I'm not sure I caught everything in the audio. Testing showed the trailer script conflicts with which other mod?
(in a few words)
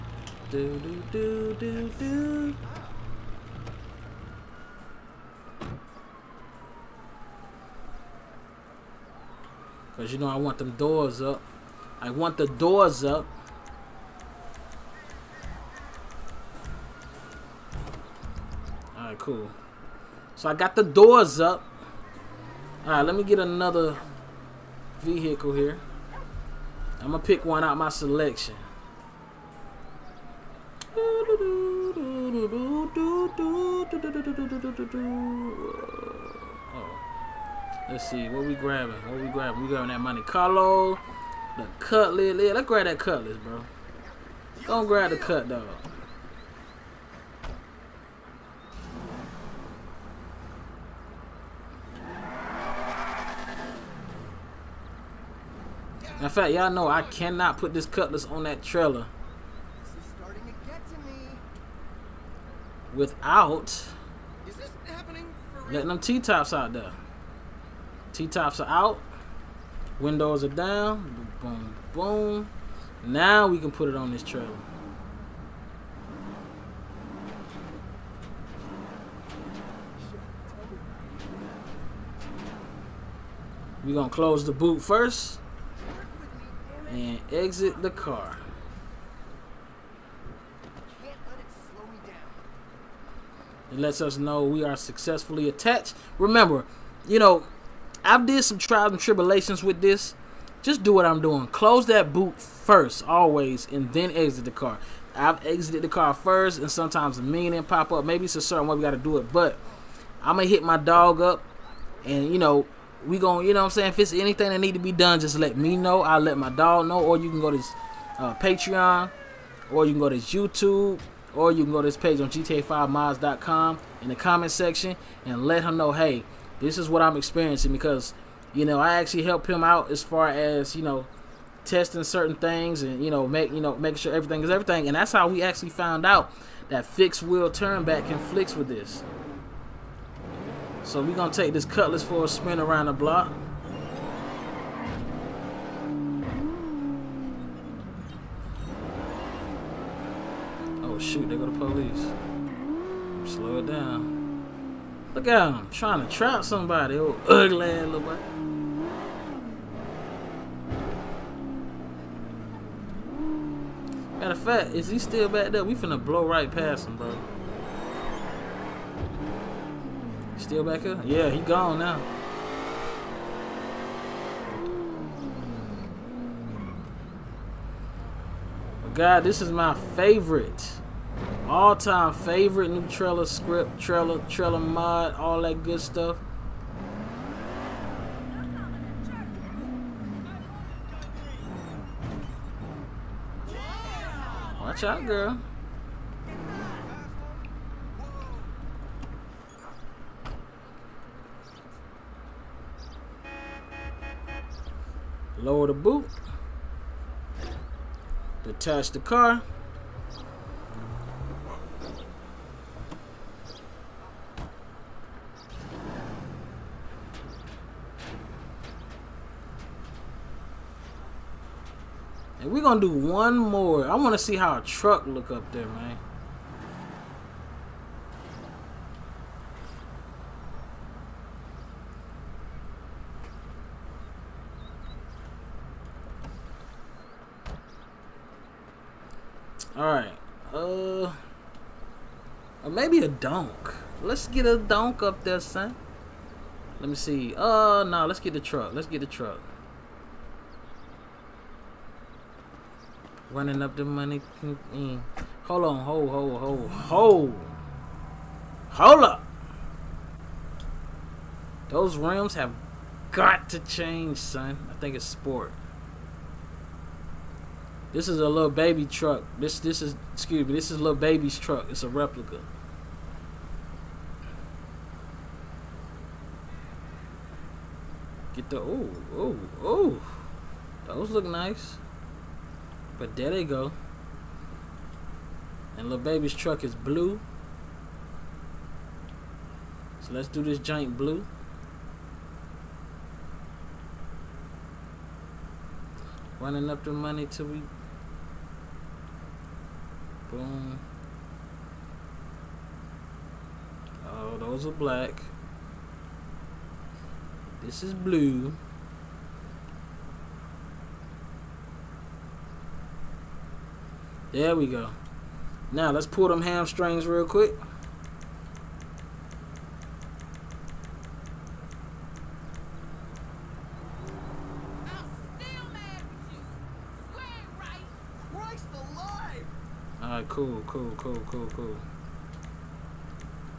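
Fixed wheel turn back.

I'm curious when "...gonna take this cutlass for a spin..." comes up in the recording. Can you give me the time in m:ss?
2:21.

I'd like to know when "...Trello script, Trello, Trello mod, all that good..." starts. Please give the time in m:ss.
3:02.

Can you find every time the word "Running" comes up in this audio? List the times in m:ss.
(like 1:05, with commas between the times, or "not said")
4:13, 4:56.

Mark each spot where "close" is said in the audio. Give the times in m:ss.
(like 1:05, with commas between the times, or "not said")
1:24, 1:41.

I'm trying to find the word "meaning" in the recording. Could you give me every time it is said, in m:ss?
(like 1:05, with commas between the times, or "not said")
1:47.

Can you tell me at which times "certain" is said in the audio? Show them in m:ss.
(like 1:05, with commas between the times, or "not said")
1:48, 2:12.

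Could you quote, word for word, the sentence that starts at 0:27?
I'm gonna pick one out my selection.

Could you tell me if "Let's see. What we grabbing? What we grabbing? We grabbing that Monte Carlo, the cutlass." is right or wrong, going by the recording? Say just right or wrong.
right.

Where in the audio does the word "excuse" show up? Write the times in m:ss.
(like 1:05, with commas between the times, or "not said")
4:30.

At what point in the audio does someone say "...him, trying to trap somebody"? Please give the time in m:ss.
2:35.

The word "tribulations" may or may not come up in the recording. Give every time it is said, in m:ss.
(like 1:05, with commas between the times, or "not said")
1:38.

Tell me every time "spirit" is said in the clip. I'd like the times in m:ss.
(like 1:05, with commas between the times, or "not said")
not said.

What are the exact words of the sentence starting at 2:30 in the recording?
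Oh, shoot, They go the police.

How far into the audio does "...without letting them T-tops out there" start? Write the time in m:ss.
1:02.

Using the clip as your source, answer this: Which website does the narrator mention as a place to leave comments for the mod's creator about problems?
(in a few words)
GTA5Mods.com.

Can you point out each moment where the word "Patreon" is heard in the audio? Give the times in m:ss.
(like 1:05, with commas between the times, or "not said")
1:58.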